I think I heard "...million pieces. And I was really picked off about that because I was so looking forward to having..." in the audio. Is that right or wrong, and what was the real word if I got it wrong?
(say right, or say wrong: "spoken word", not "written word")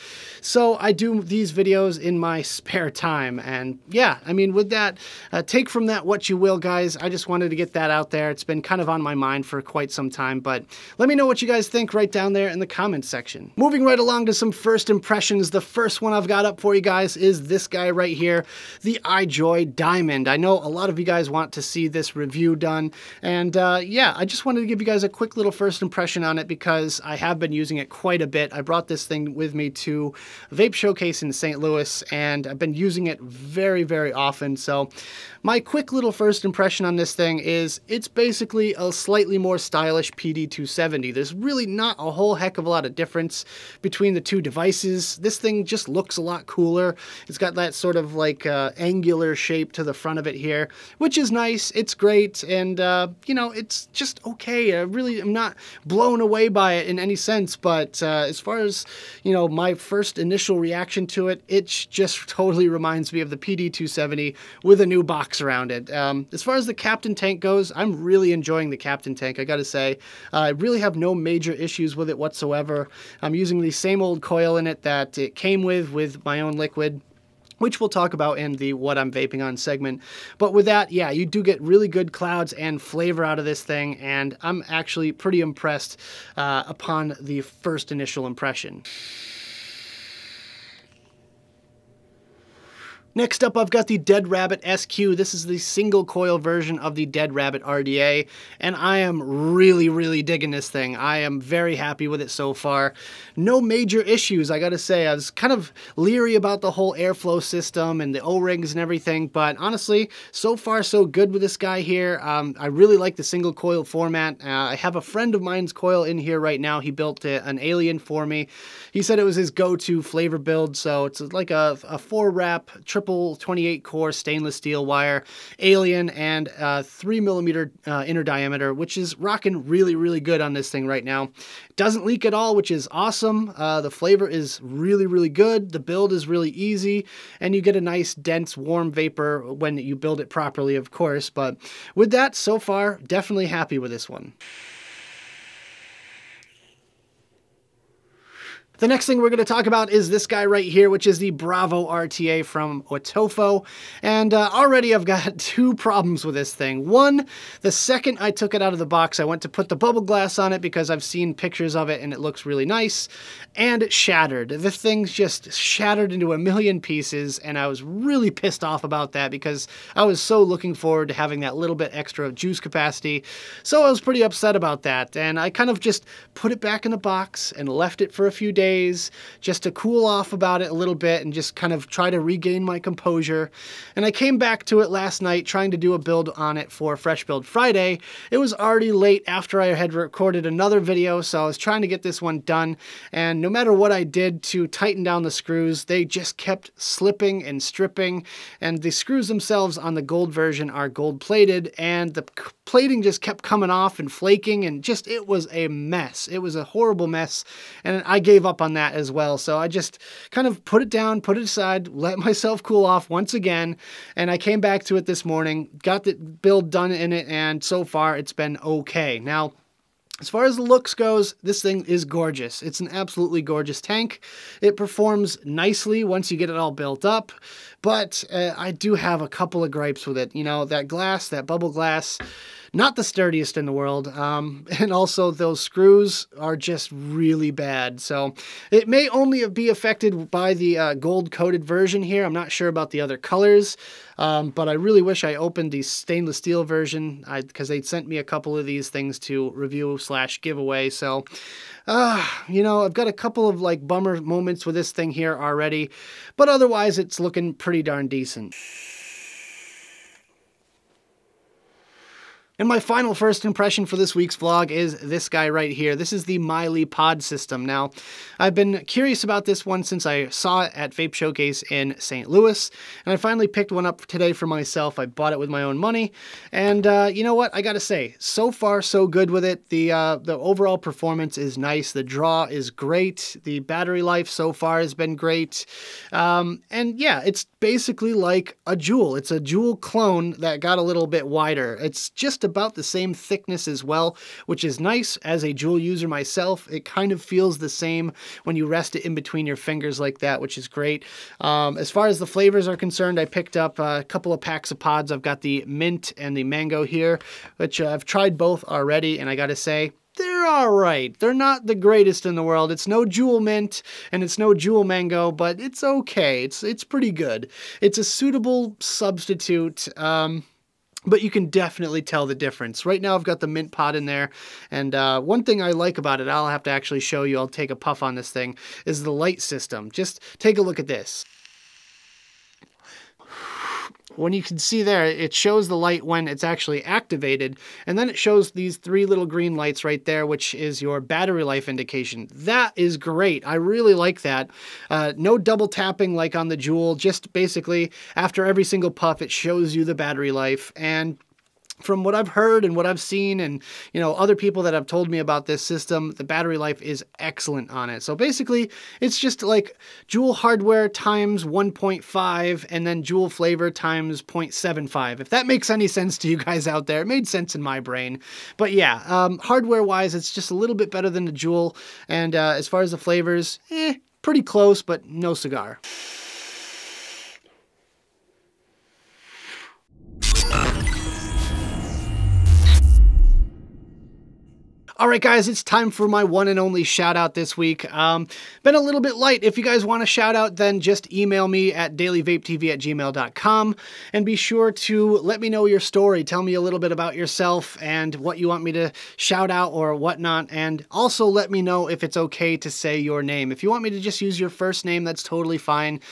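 wrong: "pissed", not "picked".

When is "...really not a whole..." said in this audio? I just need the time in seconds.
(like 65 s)
41 s.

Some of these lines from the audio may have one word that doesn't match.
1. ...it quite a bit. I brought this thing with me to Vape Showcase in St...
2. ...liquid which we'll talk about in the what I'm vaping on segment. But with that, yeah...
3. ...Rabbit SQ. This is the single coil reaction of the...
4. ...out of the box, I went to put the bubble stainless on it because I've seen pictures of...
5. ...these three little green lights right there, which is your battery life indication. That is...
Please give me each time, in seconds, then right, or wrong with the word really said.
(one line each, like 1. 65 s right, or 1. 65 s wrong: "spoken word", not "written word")
1. 27 s right
2. 76 s right
3. 94 s wrong: "version", not "reaction"
4. 158 s wrong: "glass", not "stainless"
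5. 338 s right.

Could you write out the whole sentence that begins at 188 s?
It was already late after I had recorded another video, so I was trying to get this one done.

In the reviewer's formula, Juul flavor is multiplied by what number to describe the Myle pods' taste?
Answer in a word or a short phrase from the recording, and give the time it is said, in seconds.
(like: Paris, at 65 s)
0.75, at 364 s.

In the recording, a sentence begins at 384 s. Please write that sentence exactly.
All right, guys, it's time for my one and only shout out this week.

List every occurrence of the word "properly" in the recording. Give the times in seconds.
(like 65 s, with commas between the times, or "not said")
140 s.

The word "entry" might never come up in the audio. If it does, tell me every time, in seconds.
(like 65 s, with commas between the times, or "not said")
not said.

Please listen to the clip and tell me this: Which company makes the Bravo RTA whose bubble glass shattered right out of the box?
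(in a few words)
Wotofo.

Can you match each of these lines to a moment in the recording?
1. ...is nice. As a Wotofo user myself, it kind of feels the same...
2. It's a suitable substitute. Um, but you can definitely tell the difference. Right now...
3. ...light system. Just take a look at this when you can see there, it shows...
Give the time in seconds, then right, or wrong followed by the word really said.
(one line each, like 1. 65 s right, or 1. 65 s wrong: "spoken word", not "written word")
1. 294 s wrong: "Juul", not "Wotofo"
2. 317 s right
3. 329 s right.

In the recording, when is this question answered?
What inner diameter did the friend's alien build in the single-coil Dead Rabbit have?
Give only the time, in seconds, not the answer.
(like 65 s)
126 s.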